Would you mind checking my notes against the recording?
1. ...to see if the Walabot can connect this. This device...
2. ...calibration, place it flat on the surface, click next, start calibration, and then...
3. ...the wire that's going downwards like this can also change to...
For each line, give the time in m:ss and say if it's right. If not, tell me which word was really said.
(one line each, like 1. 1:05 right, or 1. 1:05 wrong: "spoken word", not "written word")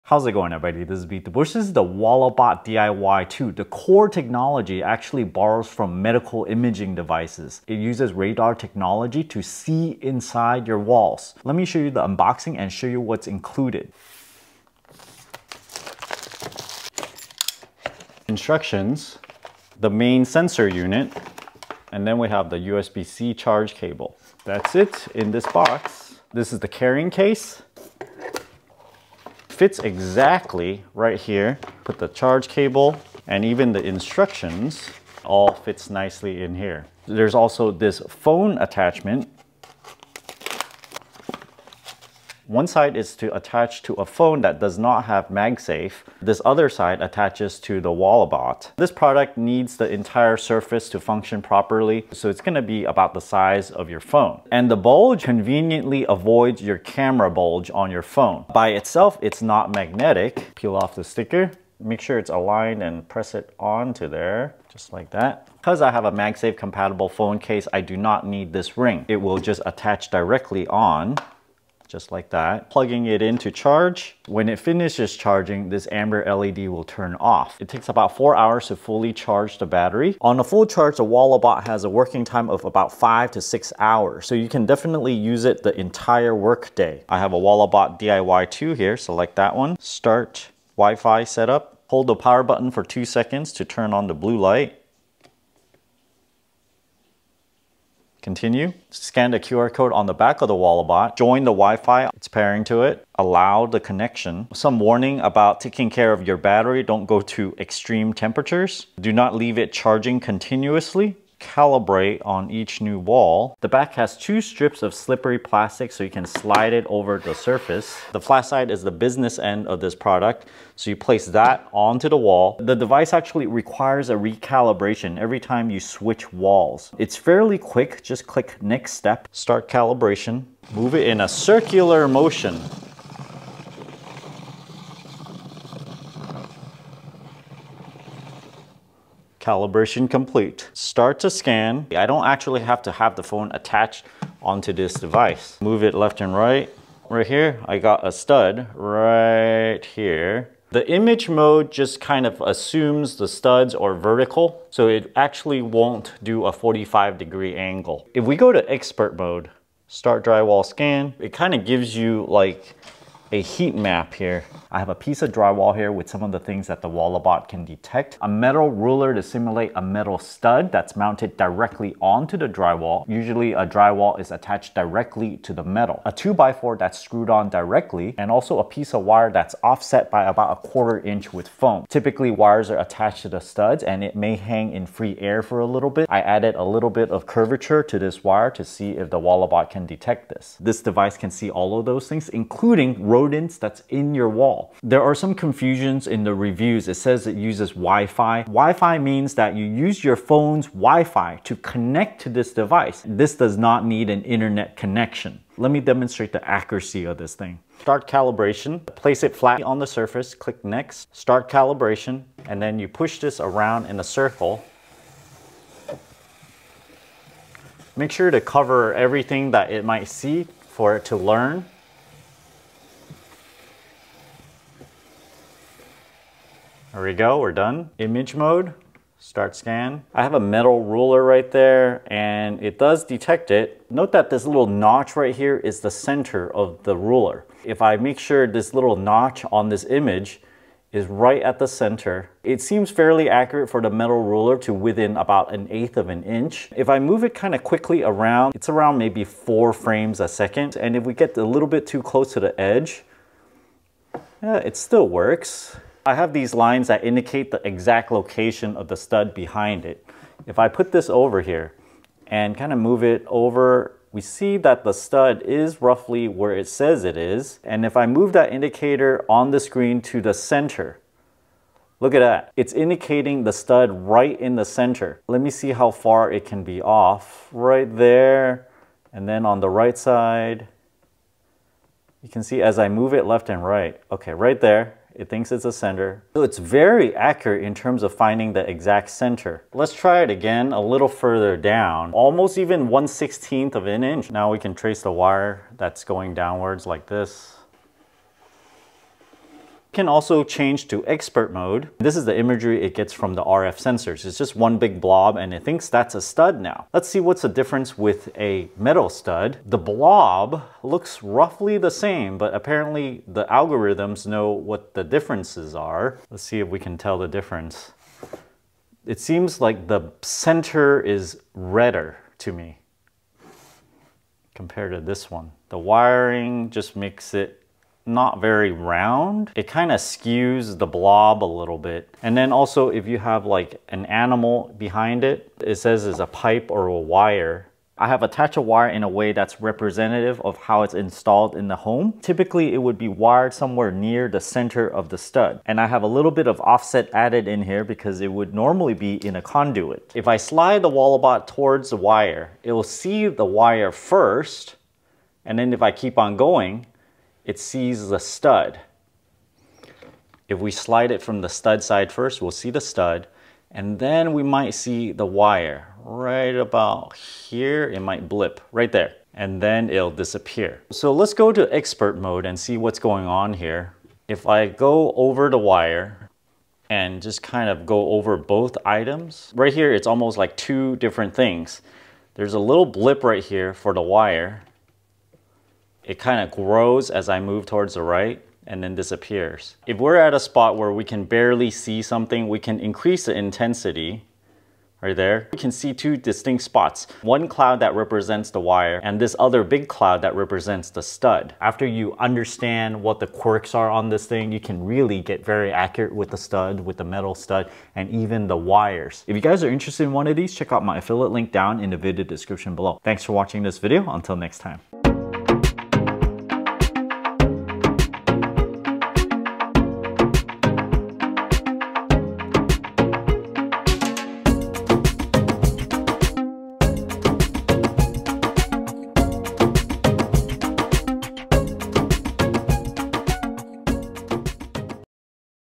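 1. 3:08 wrong: "detect", not "connect"
2. 3:28 right
3. 4:55 right.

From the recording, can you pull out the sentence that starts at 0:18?
Instructions, the main sensor unit, and then we have the USB-C charge cable.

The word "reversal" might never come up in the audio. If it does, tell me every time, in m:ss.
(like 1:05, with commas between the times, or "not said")
not said.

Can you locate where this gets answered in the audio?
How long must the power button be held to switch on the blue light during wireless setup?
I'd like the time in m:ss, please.
1:32.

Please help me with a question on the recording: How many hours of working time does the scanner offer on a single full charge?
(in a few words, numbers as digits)
5 to 6 hours.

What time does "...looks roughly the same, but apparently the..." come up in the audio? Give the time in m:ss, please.
5:10.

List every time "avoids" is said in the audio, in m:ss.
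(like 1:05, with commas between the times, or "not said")
0:56.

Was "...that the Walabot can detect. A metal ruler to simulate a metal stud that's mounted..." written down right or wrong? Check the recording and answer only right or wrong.
right.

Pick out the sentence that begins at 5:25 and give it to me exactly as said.
The wiring just makes it not very round, it kind of skews the blob a little bit.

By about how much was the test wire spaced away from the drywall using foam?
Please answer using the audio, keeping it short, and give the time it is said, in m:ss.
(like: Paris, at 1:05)
a quarter inch, at 3:00.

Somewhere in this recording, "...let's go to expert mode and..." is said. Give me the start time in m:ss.
6:11.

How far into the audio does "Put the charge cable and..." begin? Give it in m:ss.
0:31.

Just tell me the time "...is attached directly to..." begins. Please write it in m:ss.
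2:54.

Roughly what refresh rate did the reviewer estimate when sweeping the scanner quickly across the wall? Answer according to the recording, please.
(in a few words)
4 frames a second.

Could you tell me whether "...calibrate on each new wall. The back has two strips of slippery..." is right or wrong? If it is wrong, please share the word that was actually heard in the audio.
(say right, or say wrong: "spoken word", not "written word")
right.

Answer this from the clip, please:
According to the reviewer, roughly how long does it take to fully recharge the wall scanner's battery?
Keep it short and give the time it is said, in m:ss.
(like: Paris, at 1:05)
4 hours, at 1:17.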